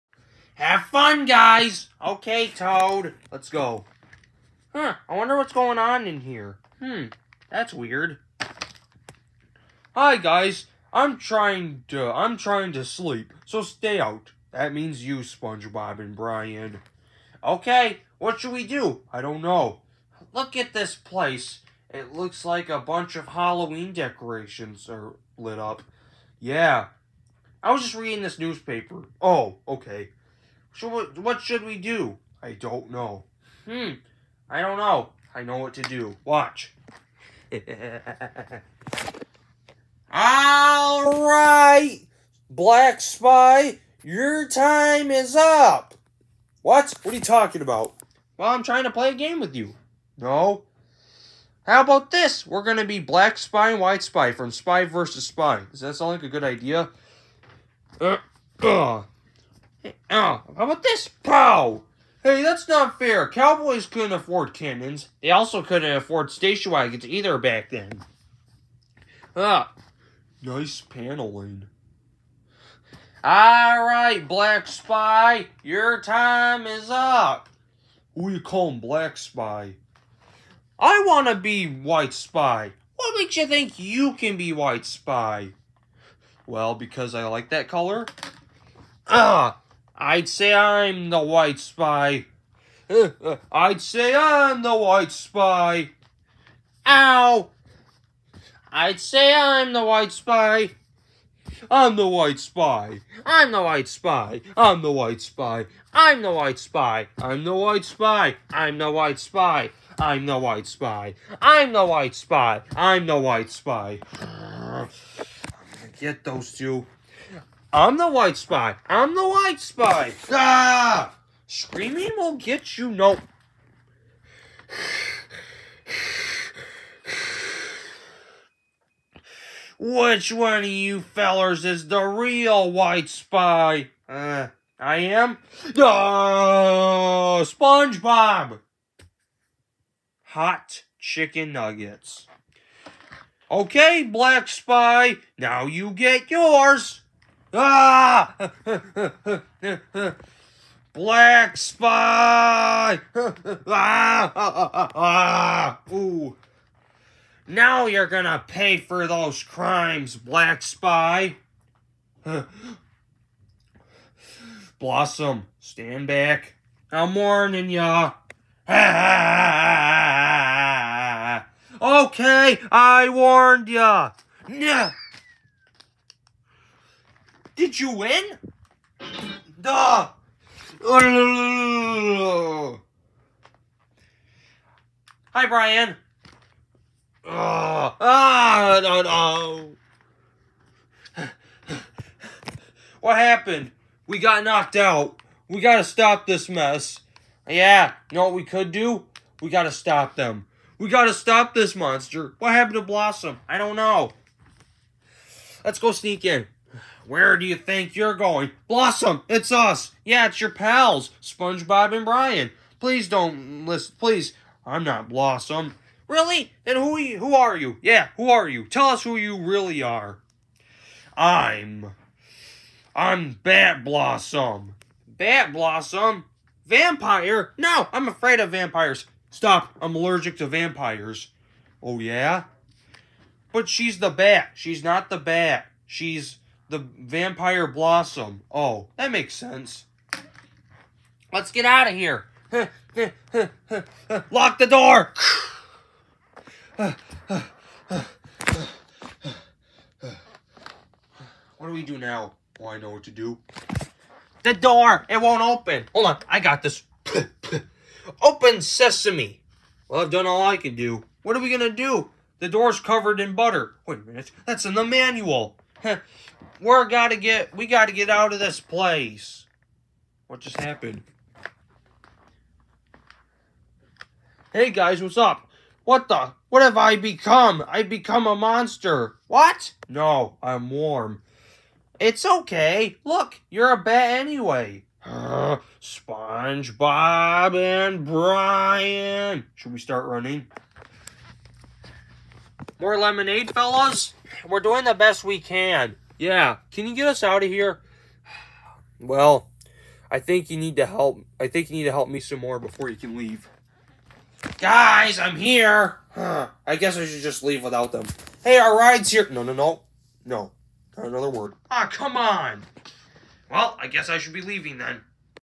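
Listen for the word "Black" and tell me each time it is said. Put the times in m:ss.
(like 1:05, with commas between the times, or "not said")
0:42, 0:52, 1:14, 1:18, 2:24, 2:30, 2:40.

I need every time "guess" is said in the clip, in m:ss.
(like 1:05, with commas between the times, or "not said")
5:06, 5:13.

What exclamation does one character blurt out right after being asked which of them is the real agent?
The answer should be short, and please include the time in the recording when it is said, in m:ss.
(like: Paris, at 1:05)
Hot chicken nuggets, at 2:20.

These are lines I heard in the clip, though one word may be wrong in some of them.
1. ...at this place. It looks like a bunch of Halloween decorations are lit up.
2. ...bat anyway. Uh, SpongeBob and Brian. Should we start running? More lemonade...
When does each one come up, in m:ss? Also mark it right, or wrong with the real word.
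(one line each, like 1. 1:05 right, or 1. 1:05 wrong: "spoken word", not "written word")
1. 0:20 right
2. 4:43 right.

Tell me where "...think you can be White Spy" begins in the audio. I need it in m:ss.
1:23.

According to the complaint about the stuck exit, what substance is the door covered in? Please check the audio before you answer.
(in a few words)
butter.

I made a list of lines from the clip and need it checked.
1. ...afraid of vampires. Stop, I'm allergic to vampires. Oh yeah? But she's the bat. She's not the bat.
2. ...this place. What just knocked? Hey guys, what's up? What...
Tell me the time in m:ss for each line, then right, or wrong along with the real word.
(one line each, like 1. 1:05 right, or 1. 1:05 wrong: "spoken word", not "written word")
1. 3:48 right
2. 4:28 wrong: "happened", not "knocked".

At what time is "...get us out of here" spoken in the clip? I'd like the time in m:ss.
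4:56.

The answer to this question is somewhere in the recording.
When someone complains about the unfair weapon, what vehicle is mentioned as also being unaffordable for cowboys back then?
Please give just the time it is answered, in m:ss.
1:06.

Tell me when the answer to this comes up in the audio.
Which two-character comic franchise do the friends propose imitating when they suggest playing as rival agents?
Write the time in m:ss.
0:54.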